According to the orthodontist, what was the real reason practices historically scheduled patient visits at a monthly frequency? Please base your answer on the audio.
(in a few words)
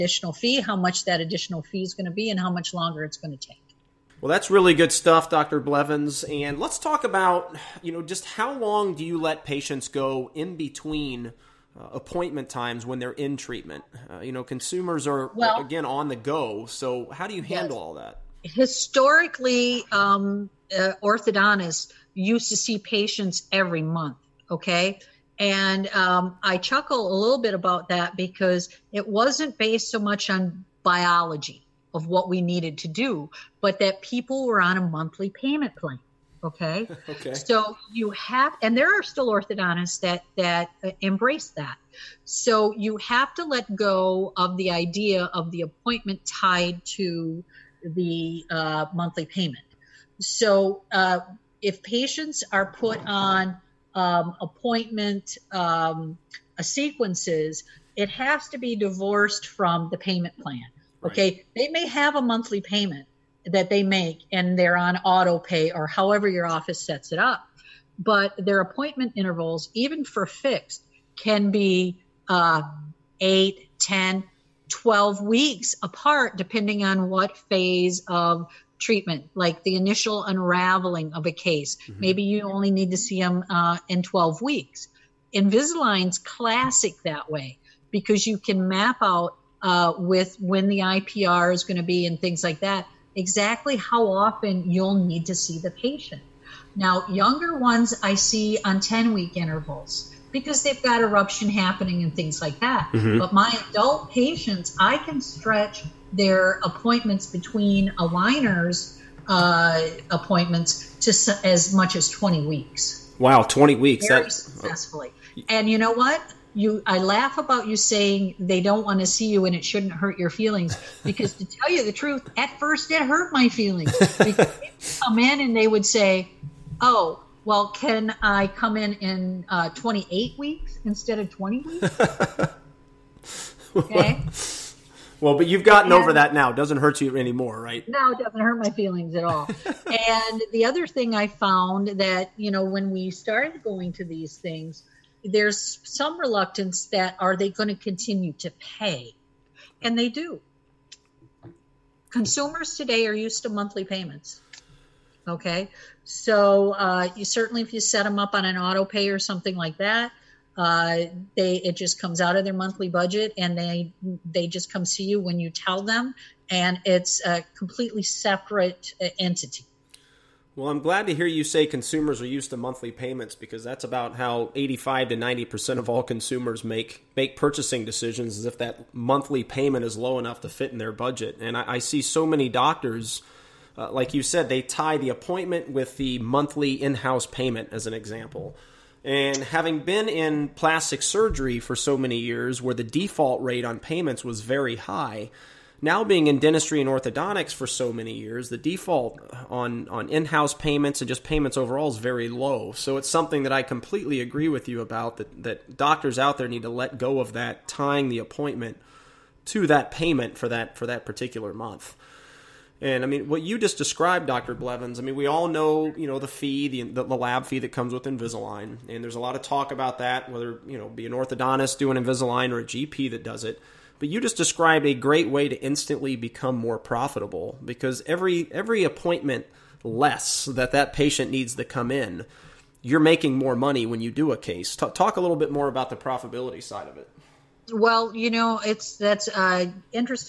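Monthly payment plan.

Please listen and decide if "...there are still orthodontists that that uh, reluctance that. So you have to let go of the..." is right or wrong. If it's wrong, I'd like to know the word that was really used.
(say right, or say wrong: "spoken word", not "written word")
wrong: "embrace", not "reluctance".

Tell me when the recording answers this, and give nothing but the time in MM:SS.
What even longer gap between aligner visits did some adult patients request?
02:09.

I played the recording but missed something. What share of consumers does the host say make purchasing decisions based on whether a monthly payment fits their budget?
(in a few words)
85 to 90 percent.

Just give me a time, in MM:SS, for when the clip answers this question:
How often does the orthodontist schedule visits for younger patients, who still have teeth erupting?
01:38.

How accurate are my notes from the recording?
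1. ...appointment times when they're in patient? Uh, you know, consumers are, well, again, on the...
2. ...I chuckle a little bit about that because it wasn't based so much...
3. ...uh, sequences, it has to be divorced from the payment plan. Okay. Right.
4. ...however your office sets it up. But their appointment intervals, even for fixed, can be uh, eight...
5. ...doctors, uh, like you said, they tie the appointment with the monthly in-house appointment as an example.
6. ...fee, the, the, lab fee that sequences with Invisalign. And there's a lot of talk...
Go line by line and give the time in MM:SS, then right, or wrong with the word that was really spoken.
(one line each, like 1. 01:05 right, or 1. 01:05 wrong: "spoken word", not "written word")
1. 00:11 wrong: "treatment", not "patient"
2. 00:26 right
3. 00:56 right
4. 01:05 right
5. 03:02 wrong: "payment", not "appointment"
6. 03:36 wrong: "comes", not "sequences".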